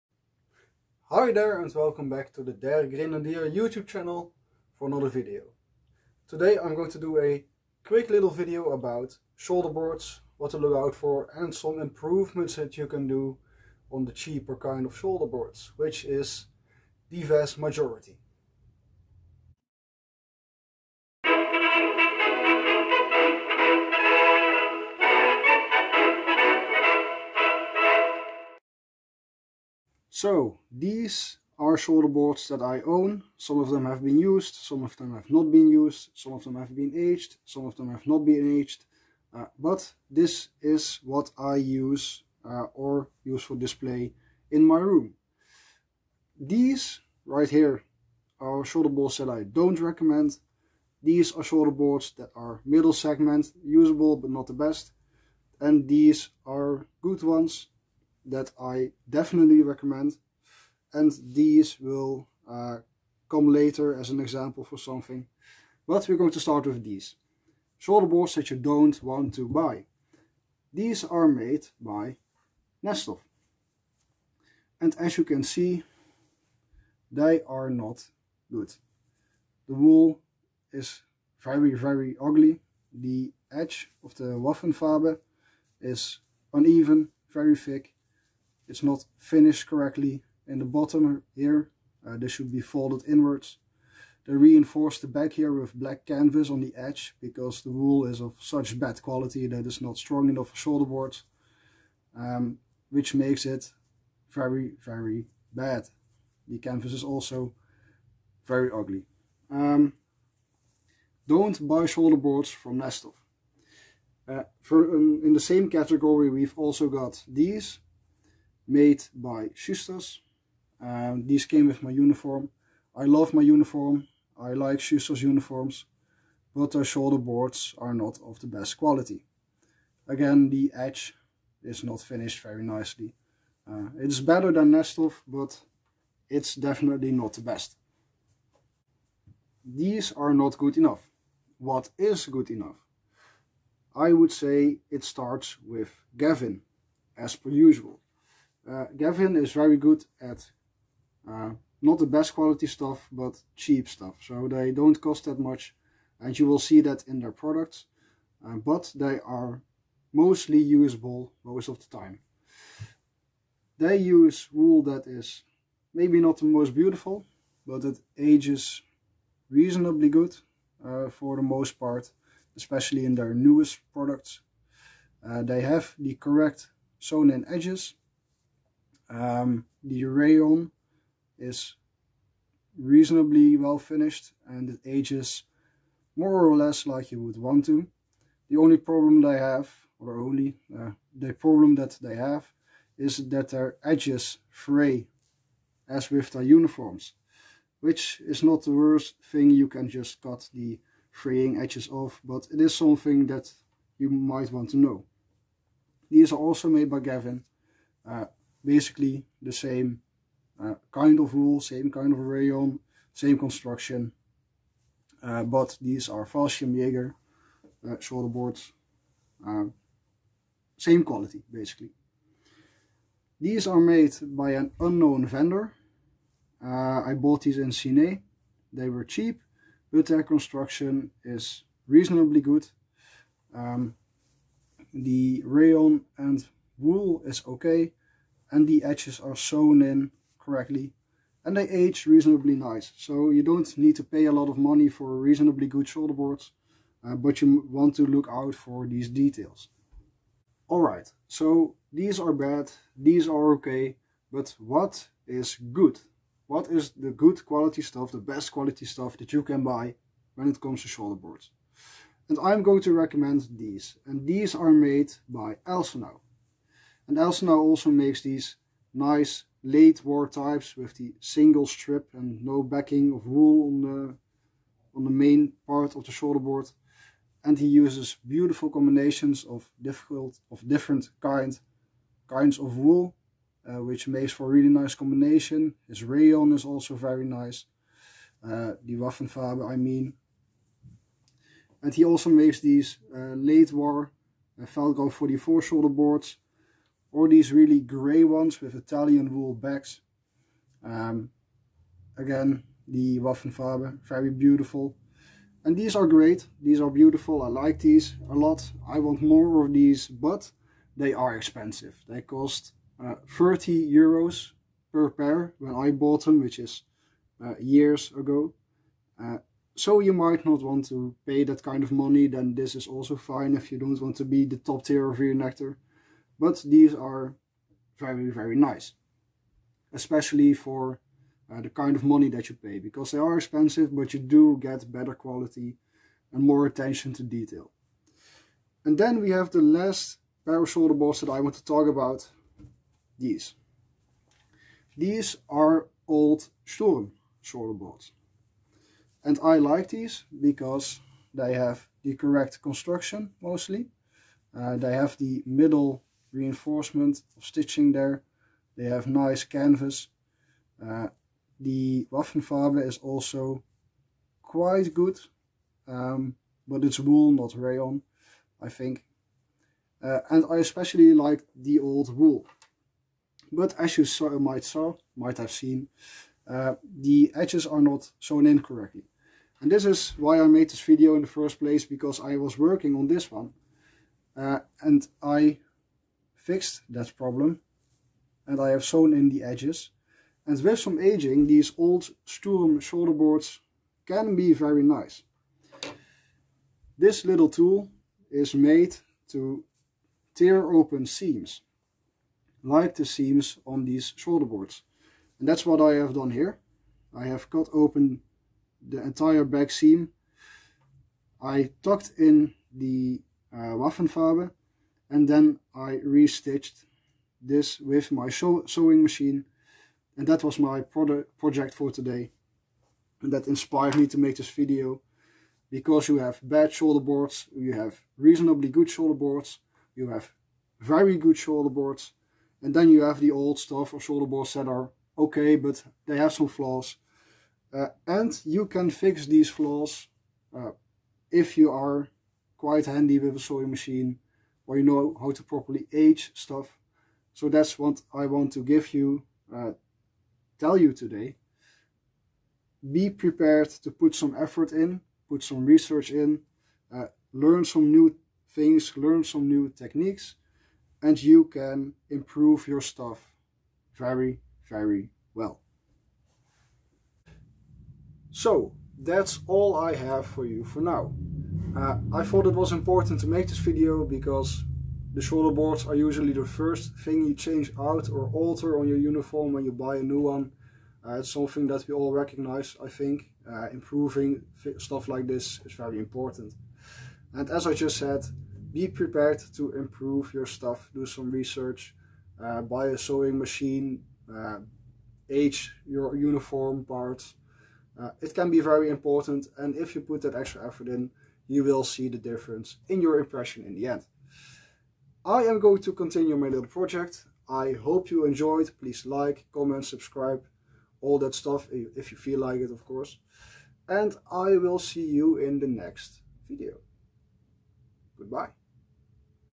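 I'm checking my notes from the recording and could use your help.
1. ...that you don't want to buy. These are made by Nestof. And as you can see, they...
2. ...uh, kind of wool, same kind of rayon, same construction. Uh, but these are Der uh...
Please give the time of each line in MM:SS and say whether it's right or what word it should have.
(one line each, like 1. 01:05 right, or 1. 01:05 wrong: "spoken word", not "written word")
1. 01:08 right
2. 03:30 wrong: "Fallschirmjäger", not "Der".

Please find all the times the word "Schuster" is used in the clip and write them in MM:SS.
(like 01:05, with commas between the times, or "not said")
01:59, 02:04.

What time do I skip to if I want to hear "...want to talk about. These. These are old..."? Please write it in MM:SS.
05:41.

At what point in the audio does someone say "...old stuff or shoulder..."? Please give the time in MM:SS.
07:13.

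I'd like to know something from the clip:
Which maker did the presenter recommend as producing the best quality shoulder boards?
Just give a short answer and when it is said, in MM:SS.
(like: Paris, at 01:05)
Elsenau, at 04:25.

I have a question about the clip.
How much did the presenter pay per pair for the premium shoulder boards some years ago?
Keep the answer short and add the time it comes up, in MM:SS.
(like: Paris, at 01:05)
30 euros, at 05:13.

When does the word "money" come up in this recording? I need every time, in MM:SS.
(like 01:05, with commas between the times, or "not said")
04:04, 05:21, 05:32.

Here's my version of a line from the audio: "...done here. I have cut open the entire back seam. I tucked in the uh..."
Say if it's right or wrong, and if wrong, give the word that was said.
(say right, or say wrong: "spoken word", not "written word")
right.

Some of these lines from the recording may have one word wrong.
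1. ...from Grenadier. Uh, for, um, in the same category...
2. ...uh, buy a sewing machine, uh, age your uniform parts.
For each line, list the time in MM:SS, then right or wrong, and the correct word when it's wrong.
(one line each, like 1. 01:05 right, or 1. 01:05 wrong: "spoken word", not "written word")
1. 01:52 wrong: "Nestof", not "Grenadier"
2. 08:12 right.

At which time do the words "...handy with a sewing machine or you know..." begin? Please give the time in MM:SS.
07:22.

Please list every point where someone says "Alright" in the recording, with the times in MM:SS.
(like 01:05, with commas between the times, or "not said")
04:10.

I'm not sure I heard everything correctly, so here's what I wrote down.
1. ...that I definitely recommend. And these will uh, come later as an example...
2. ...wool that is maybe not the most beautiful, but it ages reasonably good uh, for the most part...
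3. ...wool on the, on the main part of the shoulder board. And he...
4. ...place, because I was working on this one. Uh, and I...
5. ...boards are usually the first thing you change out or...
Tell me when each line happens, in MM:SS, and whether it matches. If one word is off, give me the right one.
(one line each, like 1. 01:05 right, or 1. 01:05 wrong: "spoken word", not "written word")
1. 00:58 right
2. 02:44 right
3. 04:33 right
4. 06:21 right
5. 07:55 right.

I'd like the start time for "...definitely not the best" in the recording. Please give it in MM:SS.
02:16.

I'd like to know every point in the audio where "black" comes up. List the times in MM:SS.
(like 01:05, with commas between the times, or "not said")
01:35.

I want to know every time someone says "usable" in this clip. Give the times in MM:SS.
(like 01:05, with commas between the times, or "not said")
00:53, 02:40.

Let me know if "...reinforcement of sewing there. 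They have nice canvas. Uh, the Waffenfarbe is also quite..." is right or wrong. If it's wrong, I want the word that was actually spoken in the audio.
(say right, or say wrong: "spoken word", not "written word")
wrong: "stitching", not "sewing".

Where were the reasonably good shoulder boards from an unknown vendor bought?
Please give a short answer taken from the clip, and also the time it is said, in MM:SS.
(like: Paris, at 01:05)
Cine, at 03:47.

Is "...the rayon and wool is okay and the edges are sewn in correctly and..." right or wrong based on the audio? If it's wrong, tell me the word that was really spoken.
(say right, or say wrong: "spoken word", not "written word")
right.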